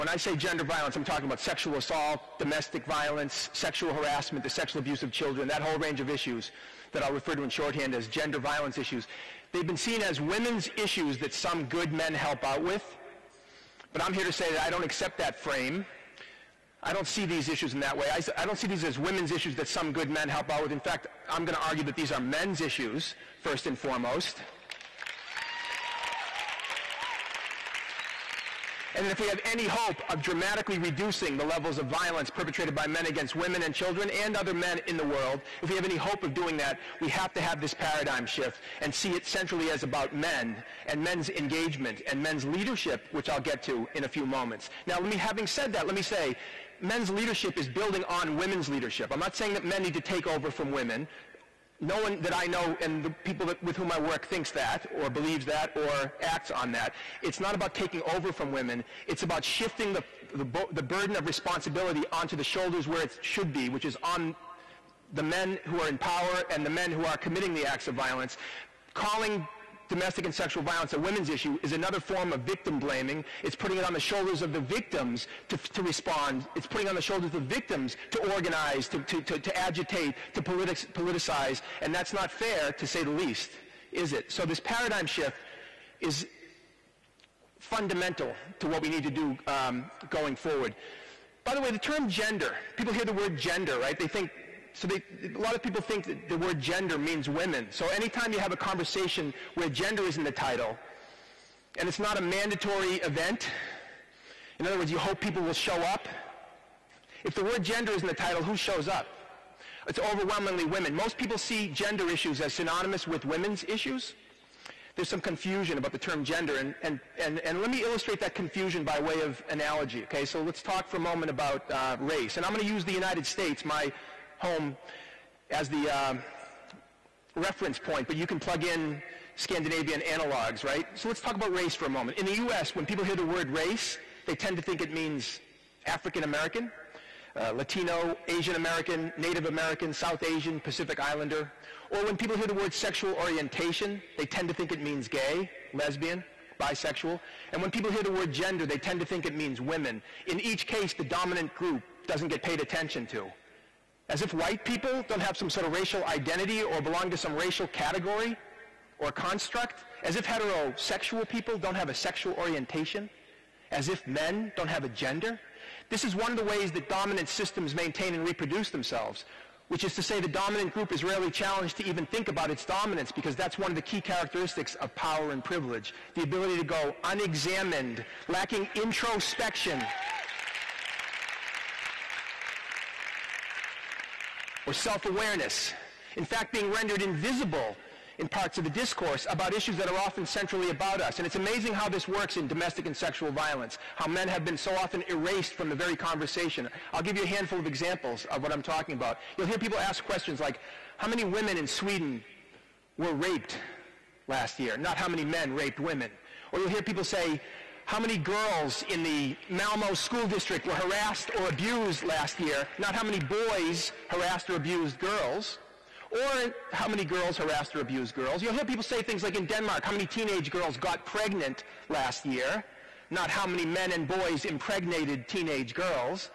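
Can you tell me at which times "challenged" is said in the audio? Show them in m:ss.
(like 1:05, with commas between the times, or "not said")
2:51.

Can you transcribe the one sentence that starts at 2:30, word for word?
In each case, the dominant group doesn't get paid attention to.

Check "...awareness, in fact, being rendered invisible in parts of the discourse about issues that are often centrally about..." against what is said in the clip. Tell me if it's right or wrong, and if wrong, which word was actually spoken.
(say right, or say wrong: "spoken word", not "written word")
right.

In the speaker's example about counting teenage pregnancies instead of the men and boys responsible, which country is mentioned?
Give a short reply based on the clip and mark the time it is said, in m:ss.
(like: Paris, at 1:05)
Denmark, at 3:39.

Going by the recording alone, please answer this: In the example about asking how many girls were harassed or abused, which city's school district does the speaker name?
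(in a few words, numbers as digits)
Malmo.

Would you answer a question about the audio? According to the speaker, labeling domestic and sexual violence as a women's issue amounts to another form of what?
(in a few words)
victim blaming.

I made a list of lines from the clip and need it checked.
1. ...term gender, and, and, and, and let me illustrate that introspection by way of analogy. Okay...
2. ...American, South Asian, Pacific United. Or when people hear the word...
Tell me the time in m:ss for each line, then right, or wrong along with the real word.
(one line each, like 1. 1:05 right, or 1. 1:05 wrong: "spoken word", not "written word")
1. 1:55 wrong: "confusion", not "introspection"
2. 2:19 wrong: "Islander", not "United".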